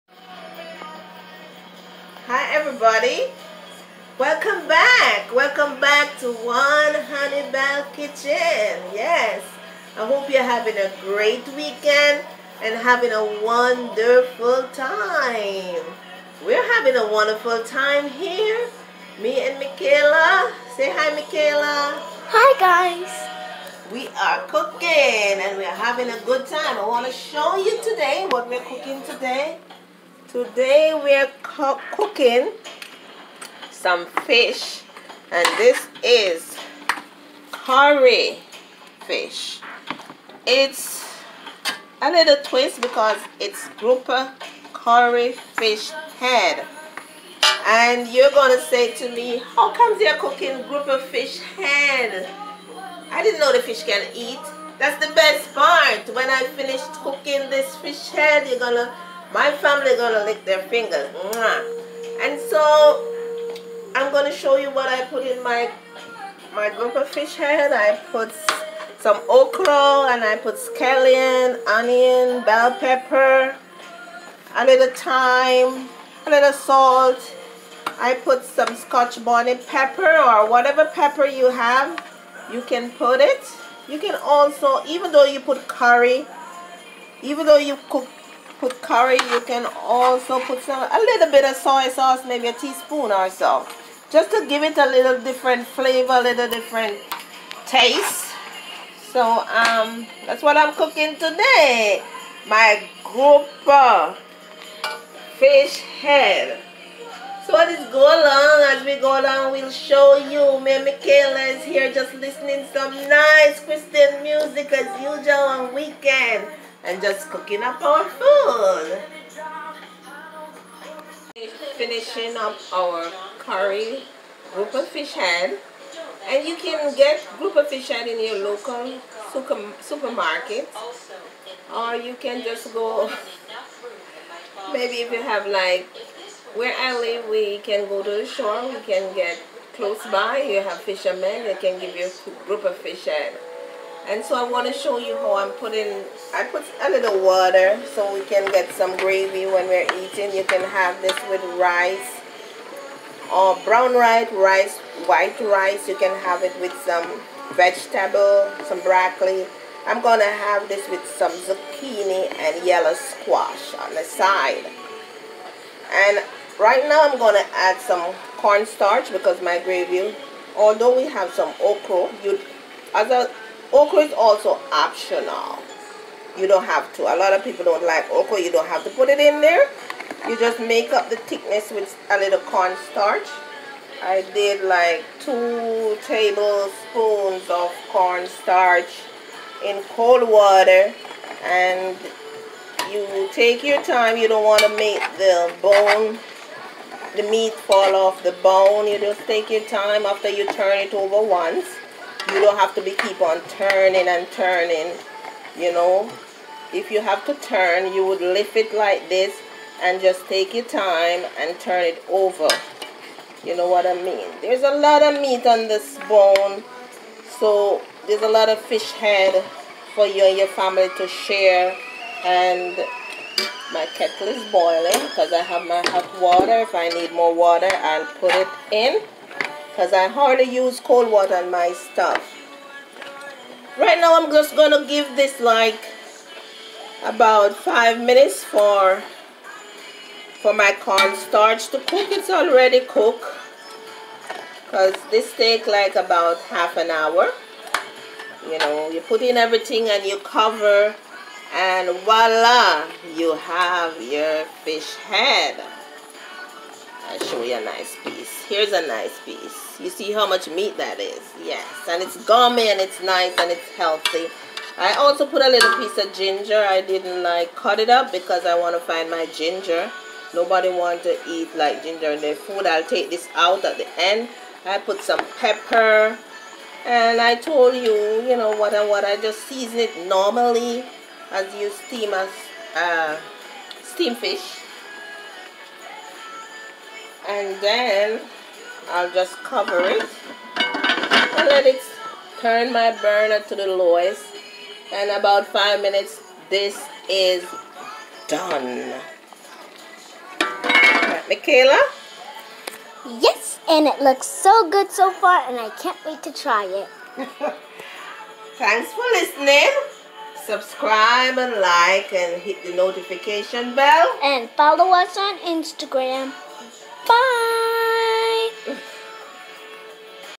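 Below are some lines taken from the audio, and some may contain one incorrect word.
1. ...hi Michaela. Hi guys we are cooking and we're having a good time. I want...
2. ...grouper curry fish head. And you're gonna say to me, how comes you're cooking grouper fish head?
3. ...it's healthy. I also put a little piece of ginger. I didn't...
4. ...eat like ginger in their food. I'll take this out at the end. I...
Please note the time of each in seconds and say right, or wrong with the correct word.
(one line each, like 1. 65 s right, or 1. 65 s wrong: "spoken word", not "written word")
1. 20 s right
2. 43 s right
3. 263 s right
4. 271 s right.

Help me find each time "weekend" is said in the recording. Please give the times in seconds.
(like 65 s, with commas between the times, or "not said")
11 s, 115 s.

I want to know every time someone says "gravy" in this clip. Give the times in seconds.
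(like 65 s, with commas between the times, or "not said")
148 s, 169 s.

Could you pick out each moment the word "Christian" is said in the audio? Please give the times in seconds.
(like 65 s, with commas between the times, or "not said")
113 s.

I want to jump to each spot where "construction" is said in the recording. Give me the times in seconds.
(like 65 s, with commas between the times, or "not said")
not said.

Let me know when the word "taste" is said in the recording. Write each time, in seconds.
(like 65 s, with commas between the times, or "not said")
97 s.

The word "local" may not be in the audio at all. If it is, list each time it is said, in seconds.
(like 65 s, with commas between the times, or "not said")
128 s.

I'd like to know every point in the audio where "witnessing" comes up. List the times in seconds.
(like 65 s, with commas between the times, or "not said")
not said.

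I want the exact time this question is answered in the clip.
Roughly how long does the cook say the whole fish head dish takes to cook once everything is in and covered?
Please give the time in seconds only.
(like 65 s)
246 s.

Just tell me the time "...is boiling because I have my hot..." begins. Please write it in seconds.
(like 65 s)
224 s.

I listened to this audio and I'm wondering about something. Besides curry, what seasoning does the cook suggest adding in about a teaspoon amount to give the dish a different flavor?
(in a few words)
Soy sauce.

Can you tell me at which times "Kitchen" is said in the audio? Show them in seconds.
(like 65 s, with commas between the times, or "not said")
7 s.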